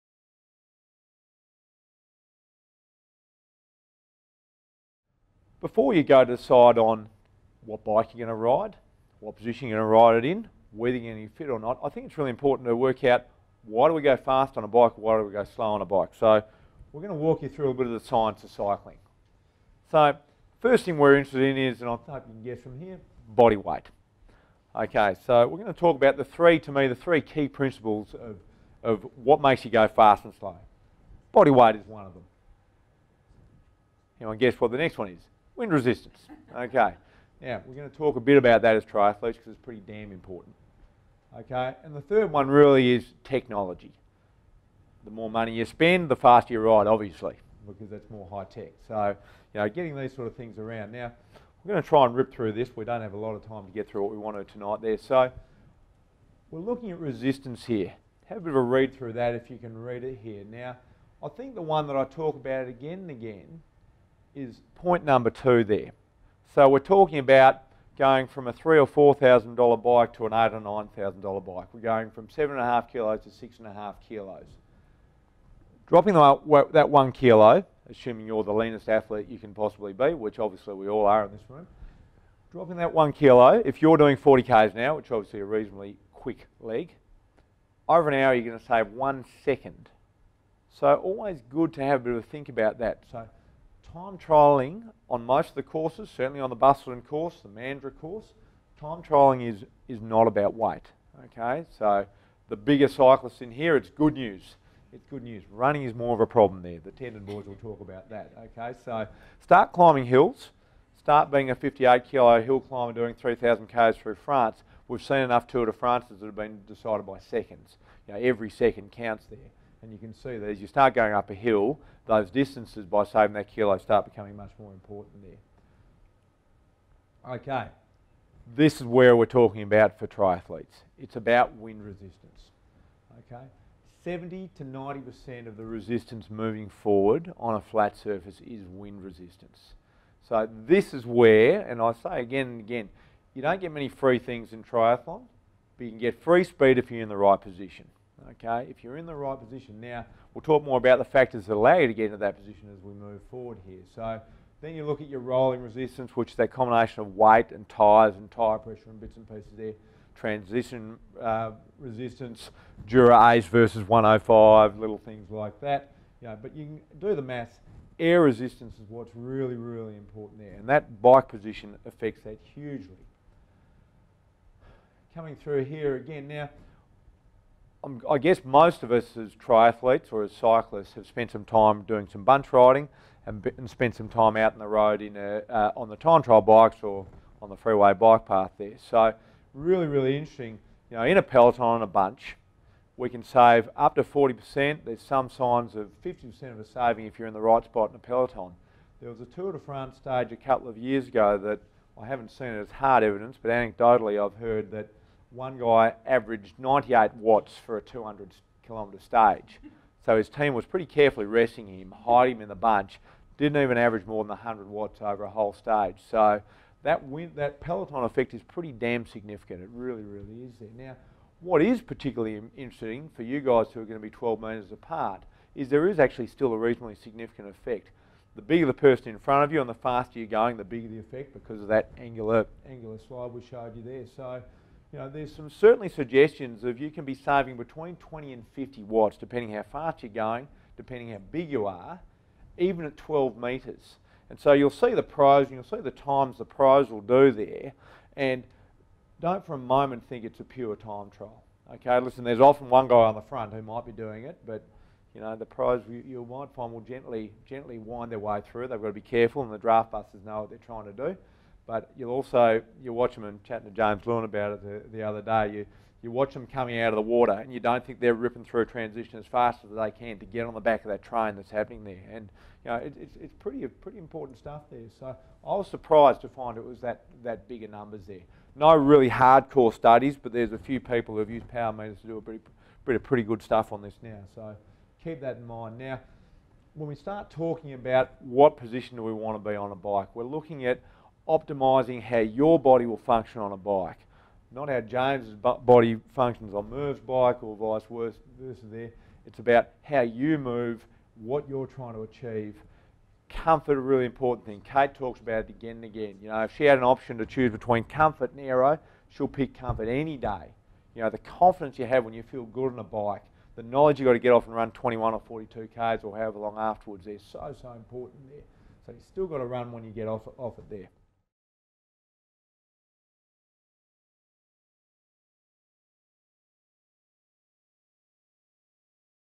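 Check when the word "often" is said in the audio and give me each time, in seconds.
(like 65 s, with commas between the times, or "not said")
252 s.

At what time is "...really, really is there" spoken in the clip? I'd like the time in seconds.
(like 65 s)
219 s.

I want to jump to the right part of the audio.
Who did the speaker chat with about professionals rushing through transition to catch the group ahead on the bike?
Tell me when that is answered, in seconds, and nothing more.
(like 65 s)
263 s.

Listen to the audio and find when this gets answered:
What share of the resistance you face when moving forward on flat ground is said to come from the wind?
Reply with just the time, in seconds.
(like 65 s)
134 s.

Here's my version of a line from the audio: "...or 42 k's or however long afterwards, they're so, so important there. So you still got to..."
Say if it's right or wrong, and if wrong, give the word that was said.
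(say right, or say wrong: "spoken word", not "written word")
right.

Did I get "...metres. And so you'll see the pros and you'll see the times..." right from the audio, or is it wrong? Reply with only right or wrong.
right.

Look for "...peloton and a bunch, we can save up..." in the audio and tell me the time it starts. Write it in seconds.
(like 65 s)
191 s.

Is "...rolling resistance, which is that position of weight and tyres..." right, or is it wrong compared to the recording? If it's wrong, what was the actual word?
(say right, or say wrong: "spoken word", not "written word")
wrong: "combination", not "position".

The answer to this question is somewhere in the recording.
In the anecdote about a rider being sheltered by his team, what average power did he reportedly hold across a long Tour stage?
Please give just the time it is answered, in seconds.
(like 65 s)
206 s.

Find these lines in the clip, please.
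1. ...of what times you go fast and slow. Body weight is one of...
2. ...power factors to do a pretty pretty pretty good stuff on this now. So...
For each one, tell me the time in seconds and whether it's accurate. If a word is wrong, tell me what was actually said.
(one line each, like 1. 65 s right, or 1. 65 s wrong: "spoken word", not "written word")
1. 28 s wrong: "makes", not "times"
2. 281 s wrong: "meters", not "factors".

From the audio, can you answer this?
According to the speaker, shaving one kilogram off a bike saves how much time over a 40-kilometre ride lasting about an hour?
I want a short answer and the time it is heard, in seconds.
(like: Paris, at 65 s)
1 second, at 88 s.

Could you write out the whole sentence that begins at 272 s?
And you know, it, it's, it's pretty pretty important stuff there.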